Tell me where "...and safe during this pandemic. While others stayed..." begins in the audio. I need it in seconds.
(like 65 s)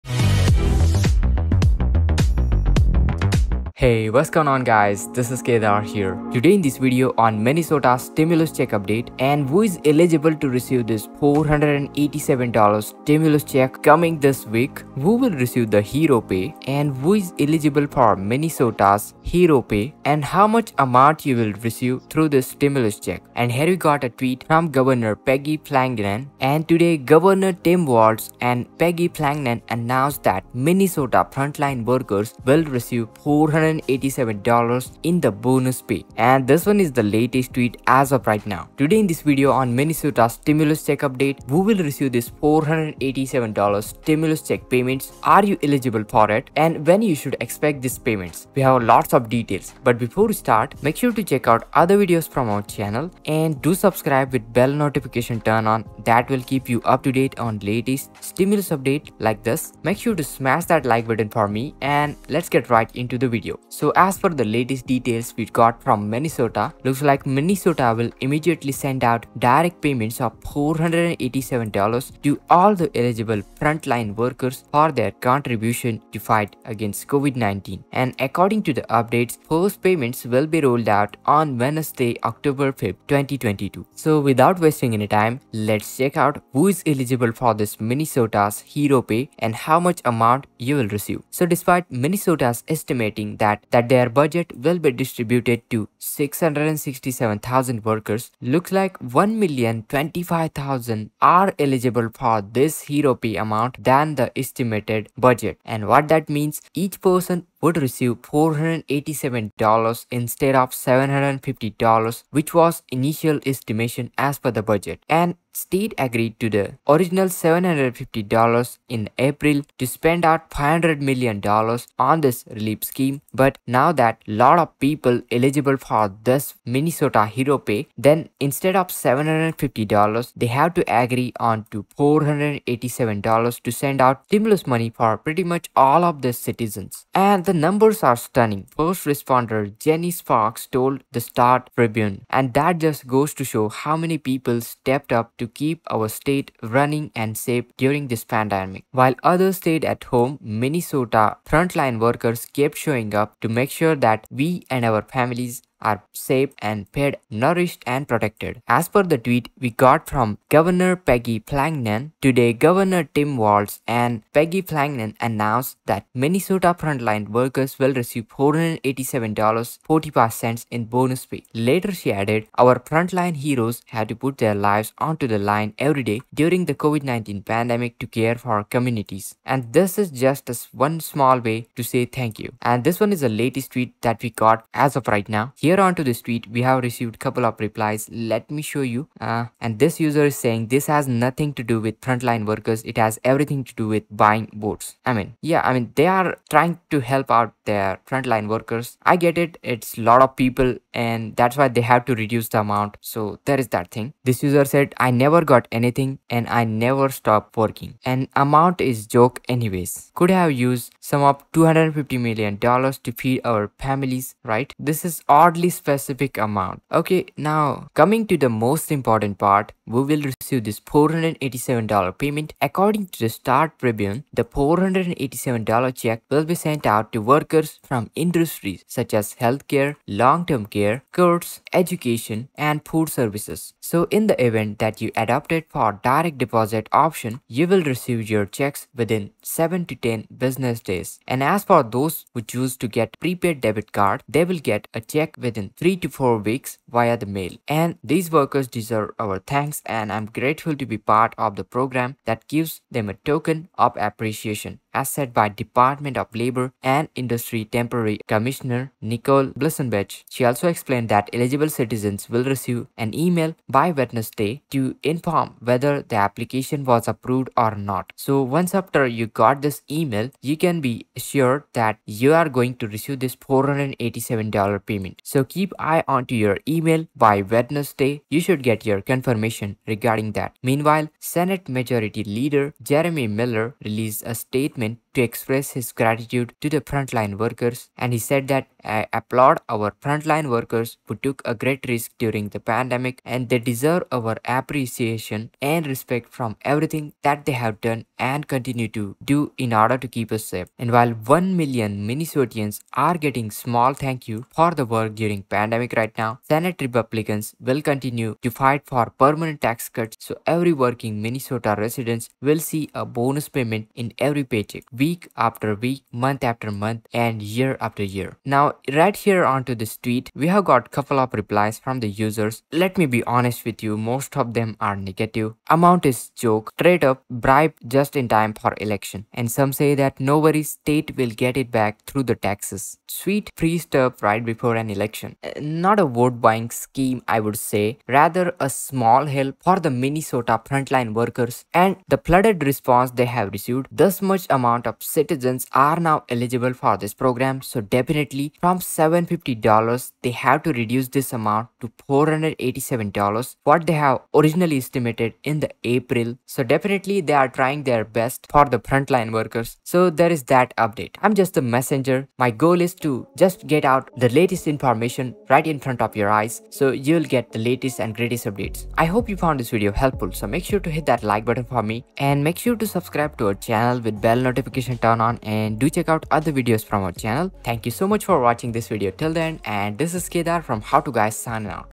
147 s.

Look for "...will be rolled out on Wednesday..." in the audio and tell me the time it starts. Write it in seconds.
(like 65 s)
80 s.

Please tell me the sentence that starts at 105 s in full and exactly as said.
And what that means, each person would receive $487 instead of $750 which was initial estimation as per the budget.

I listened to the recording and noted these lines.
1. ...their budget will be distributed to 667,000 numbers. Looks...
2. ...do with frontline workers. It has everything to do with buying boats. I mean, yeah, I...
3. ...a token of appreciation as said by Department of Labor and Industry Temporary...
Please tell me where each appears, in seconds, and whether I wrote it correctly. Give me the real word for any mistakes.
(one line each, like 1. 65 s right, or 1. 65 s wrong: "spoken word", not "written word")
1. 93 s wrong: "workers", not "numbers"
2. 191 s right
3. 253 s right.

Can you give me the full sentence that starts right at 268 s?
So once after you got this email, you can be sure that you are going to receive this $487 payment.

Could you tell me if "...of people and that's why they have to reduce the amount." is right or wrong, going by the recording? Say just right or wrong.
right.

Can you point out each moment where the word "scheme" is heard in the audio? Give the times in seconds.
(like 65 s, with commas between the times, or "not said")
122 s, 336 s.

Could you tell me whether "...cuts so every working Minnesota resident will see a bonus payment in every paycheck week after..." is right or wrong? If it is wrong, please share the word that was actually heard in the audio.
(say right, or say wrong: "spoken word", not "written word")
right.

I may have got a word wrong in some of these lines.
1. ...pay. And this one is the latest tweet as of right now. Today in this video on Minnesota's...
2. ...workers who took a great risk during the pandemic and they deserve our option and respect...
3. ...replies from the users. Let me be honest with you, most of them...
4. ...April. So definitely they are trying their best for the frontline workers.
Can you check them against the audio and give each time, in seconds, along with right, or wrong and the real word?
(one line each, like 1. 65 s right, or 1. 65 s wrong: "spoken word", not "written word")
1. 35 s right
2. 290 s wrong: "appreciation", not "option"
3. 321 s right
4. 355 s right.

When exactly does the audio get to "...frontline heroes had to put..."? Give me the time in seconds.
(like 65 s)
172 s.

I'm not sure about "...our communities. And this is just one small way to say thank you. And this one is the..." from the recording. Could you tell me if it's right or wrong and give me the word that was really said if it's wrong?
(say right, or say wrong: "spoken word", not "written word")
right.